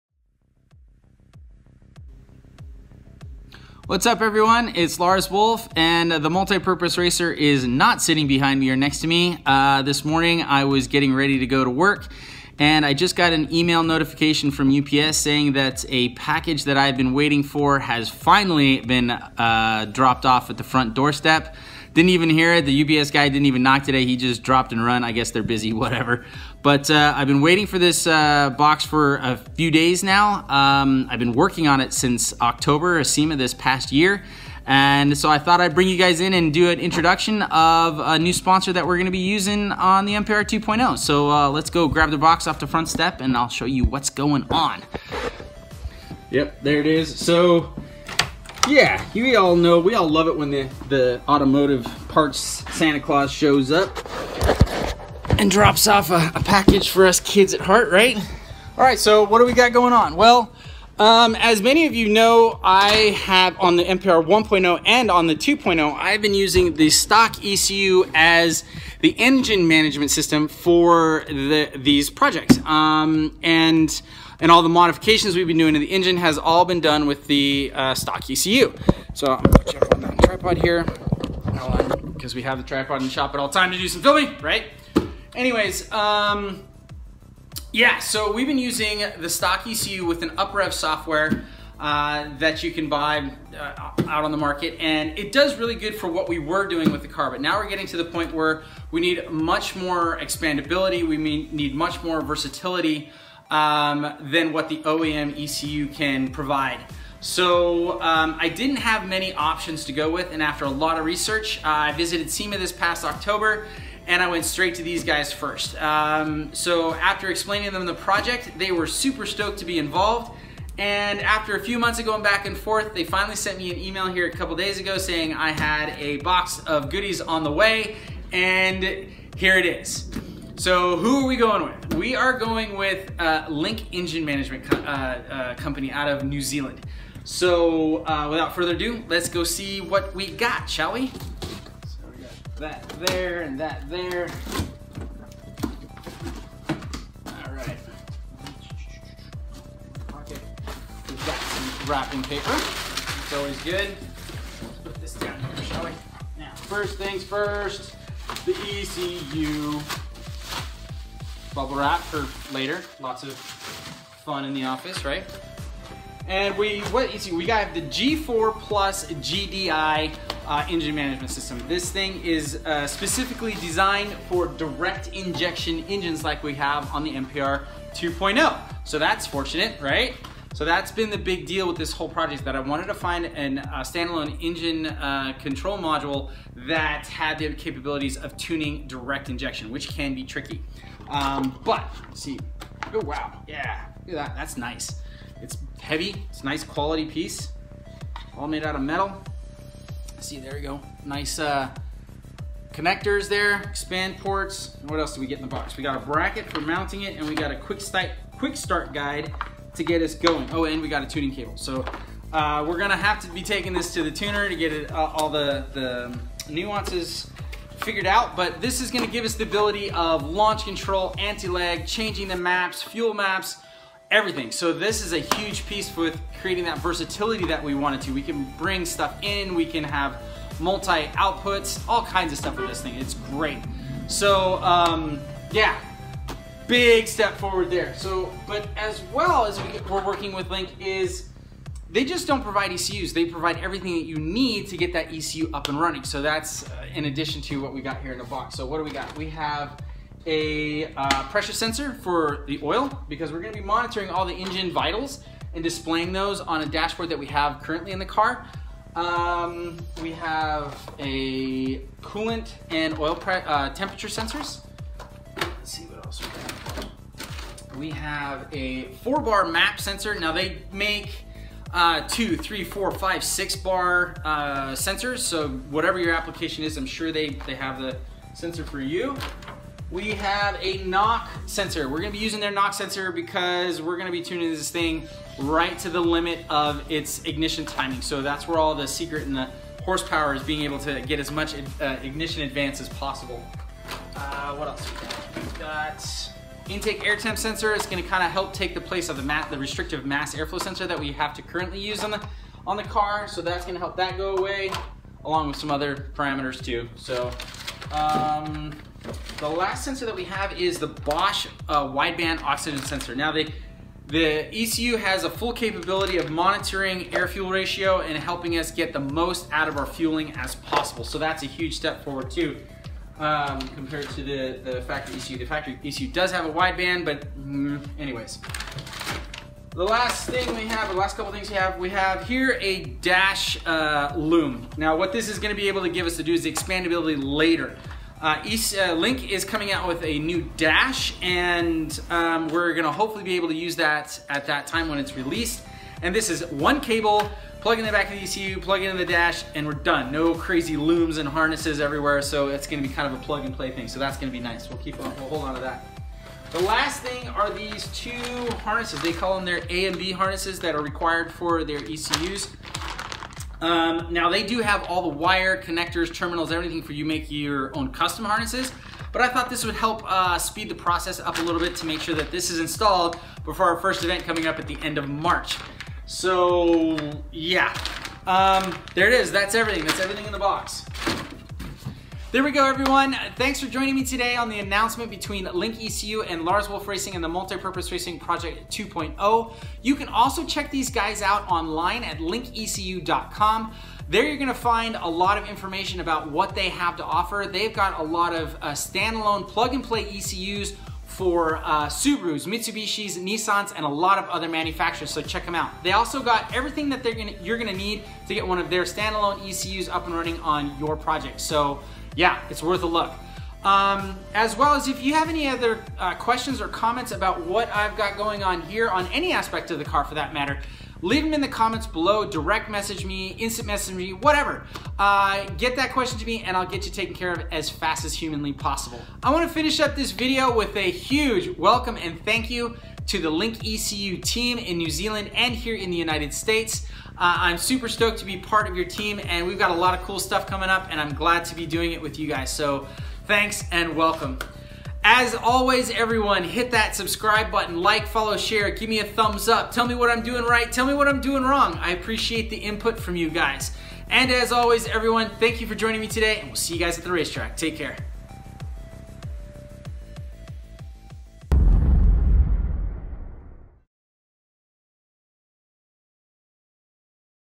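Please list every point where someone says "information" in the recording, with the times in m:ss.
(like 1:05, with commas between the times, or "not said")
6:35.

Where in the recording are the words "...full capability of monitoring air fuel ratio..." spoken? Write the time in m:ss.
5:15.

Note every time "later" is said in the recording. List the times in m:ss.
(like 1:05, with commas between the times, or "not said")
2:42, 5:37.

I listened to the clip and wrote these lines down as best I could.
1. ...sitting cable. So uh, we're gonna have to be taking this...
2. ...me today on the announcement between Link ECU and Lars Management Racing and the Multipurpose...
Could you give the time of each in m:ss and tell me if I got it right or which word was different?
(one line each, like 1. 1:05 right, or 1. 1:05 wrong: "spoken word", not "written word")
1. 3:31 wrong: "tuning", not "sitting"
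2. 6:23 wrong: "Wolfe", not "Management".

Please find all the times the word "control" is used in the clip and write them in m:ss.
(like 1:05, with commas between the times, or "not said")
3:05, 3:40.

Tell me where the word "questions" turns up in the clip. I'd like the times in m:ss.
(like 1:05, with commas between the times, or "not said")
6:56, 7:05.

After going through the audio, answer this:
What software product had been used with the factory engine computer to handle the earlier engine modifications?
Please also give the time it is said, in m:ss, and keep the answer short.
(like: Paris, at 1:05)
UpRev, at 1:30.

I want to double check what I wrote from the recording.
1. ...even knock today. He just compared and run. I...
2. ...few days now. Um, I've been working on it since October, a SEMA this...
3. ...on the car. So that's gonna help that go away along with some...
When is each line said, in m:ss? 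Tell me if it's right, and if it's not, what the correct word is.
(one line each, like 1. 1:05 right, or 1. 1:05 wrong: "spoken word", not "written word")
1. 0:23 wrong: "dropped", not "compared"
2. 0:29 right
3. 5:02 right.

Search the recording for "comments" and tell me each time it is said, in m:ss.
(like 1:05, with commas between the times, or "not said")
6:56, 7:01.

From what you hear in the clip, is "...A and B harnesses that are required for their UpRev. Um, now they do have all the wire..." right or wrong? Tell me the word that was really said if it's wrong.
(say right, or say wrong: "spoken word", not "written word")
wrong: "ECUs", not "UpRev".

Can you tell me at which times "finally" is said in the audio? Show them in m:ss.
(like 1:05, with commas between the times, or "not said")
0:18, 2:03.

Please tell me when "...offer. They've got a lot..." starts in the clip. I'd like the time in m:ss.
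6:37.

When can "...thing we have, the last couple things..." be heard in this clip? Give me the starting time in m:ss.
5:30.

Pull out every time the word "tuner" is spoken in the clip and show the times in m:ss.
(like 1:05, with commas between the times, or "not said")
3:34.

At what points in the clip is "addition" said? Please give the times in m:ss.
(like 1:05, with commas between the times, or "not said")
4:07.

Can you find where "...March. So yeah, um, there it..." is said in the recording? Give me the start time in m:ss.
6:15.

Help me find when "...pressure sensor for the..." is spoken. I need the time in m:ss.
4:11.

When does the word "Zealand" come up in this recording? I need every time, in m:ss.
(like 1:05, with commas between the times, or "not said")
2:16, 7:14.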